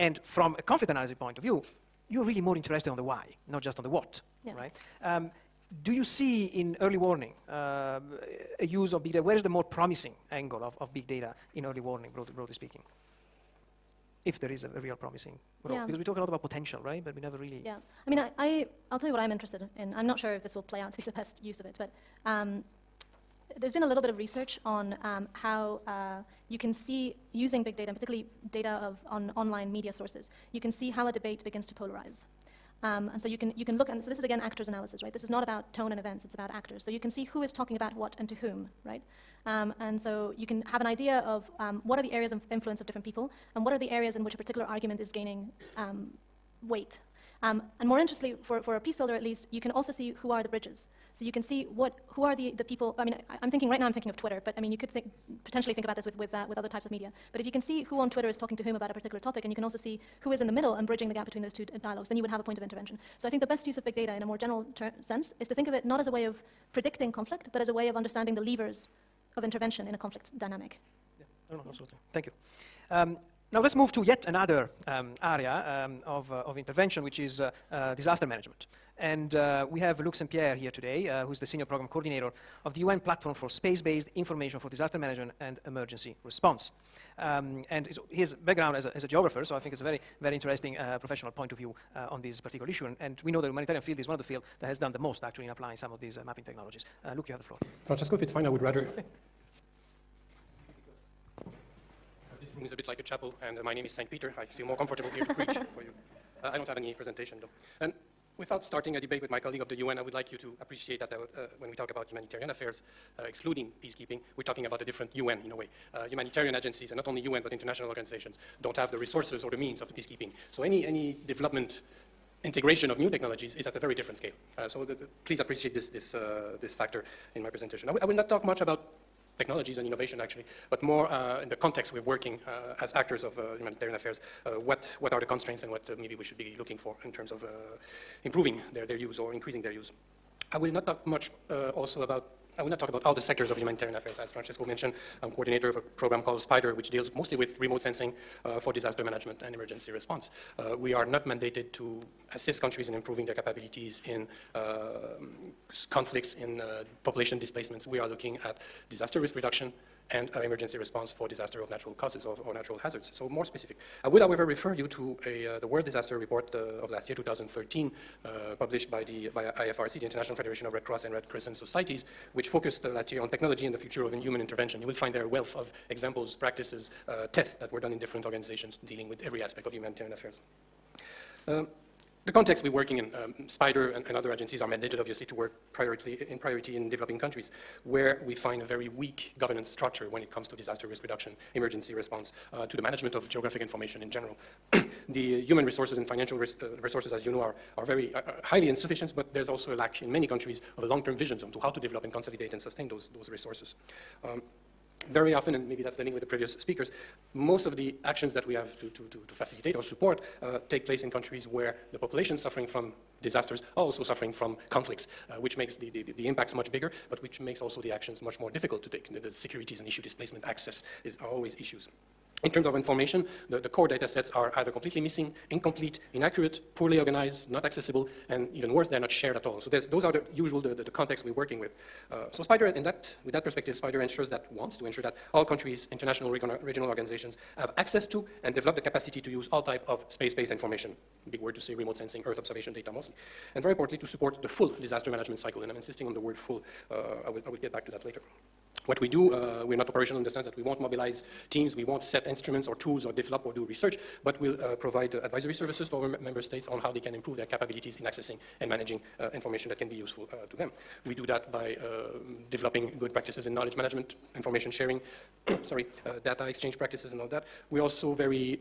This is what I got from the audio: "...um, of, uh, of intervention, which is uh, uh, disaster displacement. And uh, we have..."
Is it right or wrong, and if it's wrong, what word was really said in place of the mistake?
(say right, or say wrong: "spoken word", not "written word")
wrong: "management", not "displacement".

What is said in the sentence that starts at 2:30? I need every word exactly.
Uh, we are not mandated to assist countries in improving their capabilities in uh, conflicts, in uh, population displacements.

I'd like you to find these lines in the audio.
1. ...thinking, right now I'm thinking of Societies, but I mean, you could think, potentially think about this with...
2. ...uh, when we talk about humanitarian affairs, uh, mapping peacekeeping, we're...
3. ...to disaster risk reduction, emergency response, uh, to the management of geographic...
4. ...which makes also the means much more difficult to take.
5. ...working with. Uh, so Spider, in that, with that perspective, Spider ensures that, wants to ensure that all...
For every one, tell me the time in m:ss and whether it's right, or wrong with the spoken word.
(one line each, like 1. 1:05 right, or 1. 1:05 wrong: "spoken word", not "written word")
1. 0:53 wrong: "Twitter", not "Societies"
2. 1:51 wrong: "excluding", not "mapping"
3. 3:10 right
4. 3:37 wrong: "actions", not "means"
5. 3:51 right.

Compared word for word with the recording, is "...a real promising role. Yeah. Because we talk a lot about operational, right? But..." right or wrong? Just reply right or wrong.
wrong.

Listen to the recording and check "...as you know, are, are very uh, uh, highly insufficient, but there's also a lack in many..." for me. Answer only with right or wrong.
right.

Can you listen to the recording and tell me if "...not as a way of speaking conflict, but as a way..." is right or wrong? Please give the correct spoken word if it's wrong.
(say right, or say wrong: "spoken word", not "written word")
wrong: "predicting", not "speaking".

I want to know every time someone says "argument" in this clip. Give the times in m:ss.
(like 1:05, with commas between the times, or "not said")
0:44.